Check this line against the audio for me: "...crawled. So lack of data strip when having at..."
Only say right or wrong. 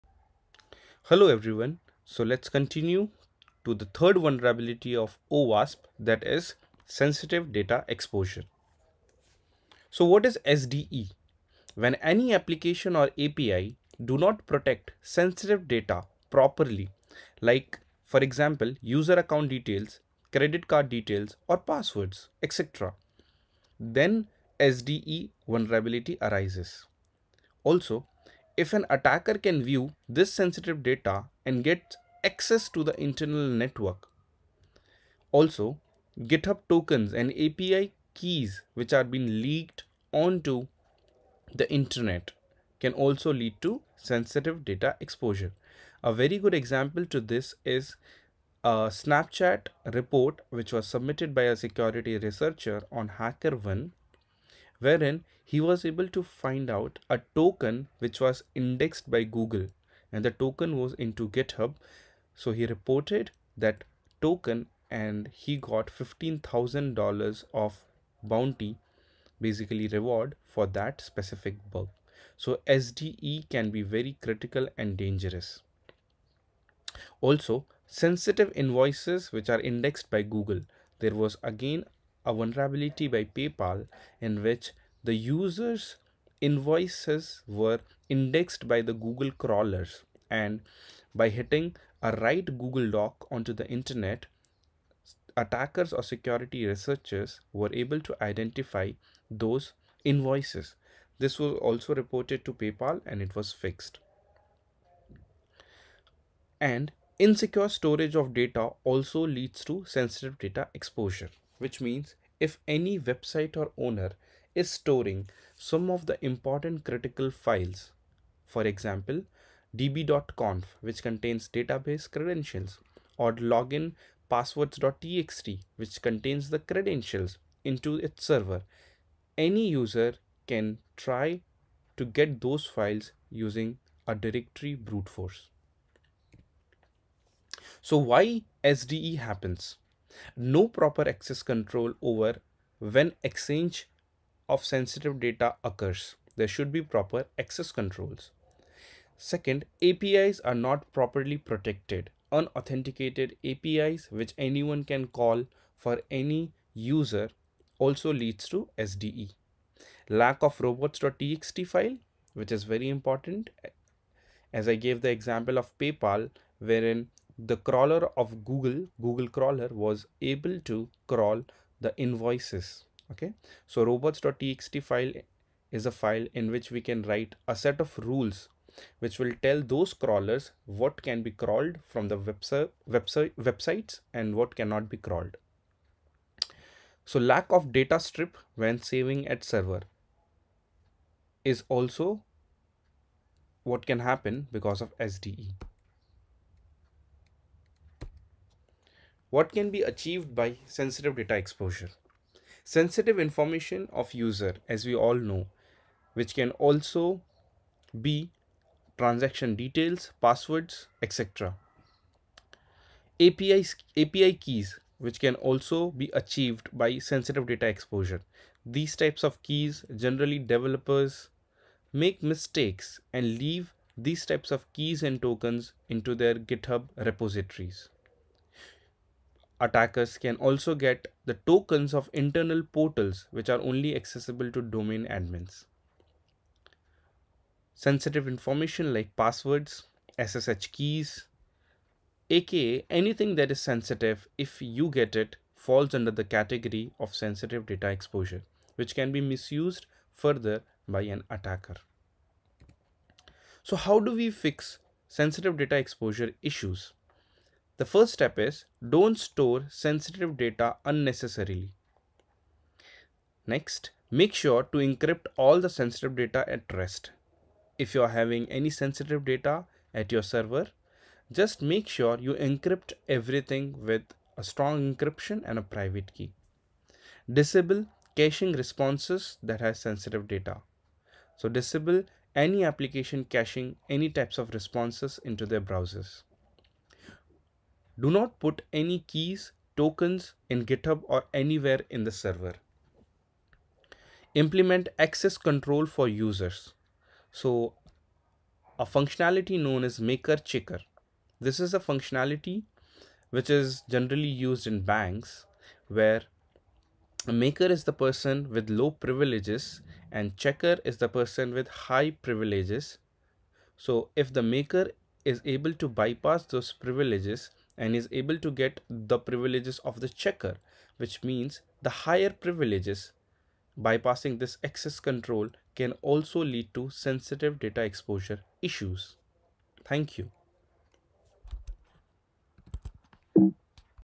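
wrong.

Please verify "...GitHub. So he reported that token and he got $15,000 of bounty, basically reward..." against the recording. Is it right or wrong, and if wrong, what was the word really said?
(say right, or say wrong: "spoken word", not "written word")
right.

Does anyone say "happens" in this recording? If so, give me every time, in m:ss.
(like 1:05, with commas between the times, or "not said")
2:19, 3:13.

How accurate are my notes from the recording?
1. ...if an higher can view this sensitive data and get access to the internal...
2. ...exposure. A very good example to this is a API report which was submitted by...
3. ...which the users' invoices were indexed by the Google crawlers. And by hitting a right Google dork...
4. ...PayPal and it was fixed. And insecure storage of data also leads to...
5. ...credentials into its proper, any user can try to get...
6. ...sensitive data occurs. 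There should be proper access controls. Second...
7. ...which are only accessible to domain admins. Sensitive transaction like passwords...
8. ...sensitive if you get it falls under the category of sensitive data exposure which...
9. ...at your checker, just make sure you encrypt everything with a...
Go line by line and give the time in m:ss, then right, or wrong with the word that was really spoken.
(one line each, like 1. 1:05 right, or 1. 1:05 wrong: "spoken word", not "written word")
1. 0:28 wrong: "attacker", not "higher"
2. 0:44 wrong: "Snapchat", not "API"
3. 1:24 right
4. 1:42 right
5. 2:06 wrong: "server", not "proper"
6. 2:24 right
7. 3:53 wrong: "information", not "transaction"
8. 4:03 right
9. 4:29 wrong: "server", not "checker".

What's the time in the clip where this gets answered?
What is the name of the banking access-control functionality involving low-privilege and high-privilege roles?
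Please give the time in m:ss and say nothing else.
4:59.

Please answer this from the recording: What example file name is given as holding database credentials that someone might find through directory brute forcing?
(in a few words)
db.conf.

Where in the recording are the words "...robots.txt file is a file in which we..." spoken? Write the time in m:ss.
2:53.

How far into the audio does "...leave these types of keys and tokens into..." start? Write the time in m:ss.
3:43.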